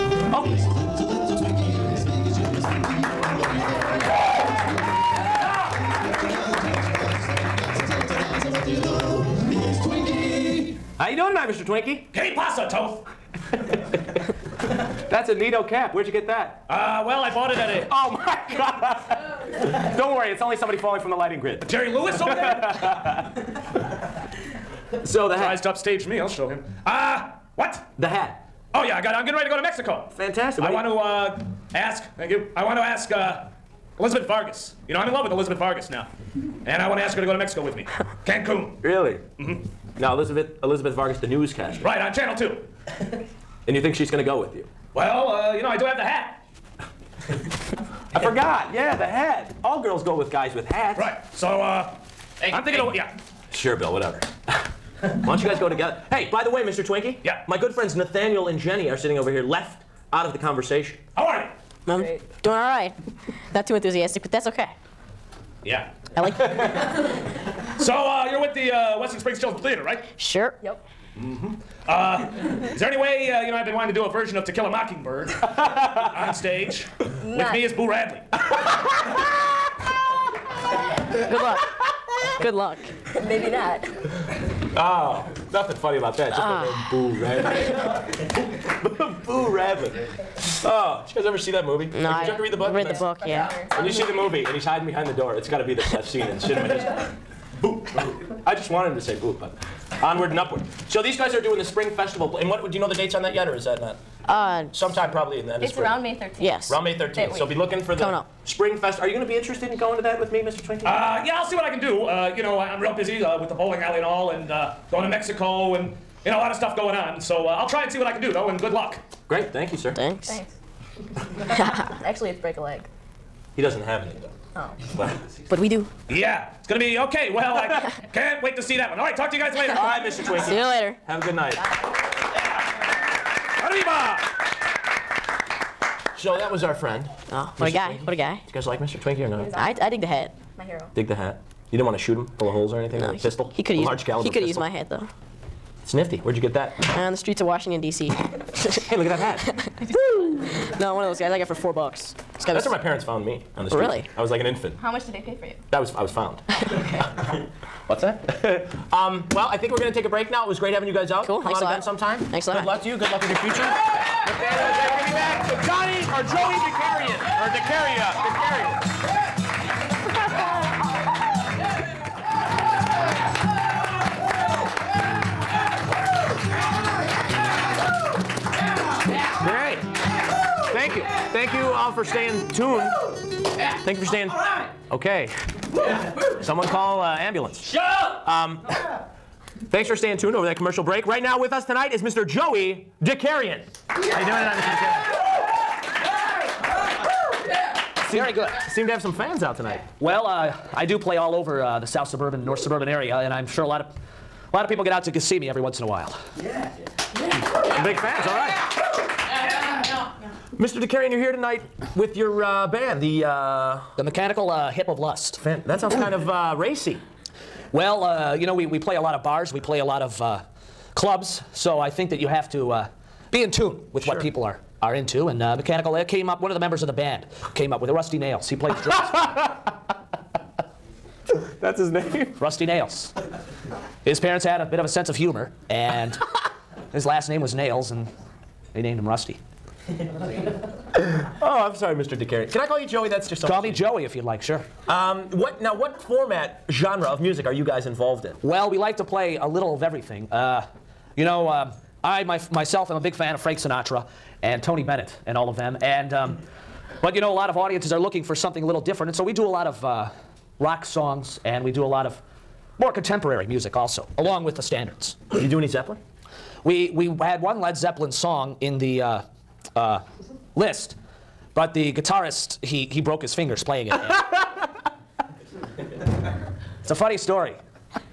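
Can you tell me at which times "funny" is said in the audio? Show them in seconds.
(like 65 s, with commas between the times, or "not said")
85 s, 276 s.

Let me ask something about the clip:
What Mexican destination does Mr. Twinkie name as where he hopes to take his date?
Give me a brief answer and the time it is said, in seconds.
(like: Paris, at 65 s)
Cancun, at 38 s.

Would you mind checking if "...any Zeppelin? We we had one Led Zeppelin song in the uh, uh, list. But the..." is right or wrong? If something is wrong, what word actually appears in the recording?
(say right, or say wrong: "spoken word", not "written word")
right.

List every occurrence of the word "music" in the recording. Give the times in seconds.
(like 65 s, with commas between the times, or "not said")
247 s, 263 s.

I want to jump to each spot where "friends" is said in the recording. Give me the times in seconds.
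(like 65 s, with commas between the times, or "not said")
57 s, 136 s.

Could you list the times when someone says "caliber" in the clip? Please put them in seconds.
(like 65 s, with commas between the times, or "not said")
144 s.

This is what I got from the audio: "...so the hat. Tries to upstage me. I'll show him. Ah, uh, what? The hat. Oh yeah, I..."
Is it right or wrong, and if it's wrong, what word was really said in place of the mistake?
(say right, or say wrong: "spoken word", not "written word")
right.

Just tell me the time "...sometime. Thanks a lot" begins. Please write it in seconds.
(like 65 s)
161 s.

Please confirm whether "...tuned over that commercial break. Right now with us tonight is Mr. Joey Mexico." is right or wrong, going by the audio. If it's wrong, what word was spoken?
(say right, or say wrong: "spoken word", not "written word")
wrong: "DeCarrion", not "Mexico".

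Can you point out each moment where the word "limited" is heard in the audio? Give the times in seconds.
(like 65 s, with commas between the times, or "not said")
not said.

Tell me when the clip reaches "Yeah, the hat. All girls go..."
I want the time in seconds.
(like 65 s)
48 s.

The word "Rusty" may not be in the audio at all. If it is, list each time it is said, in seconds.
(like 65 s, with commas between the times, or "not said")
227 s, 232 s, 239 s.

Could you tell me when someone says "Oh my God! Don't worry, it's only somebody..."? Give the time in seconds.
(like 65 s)
17 s.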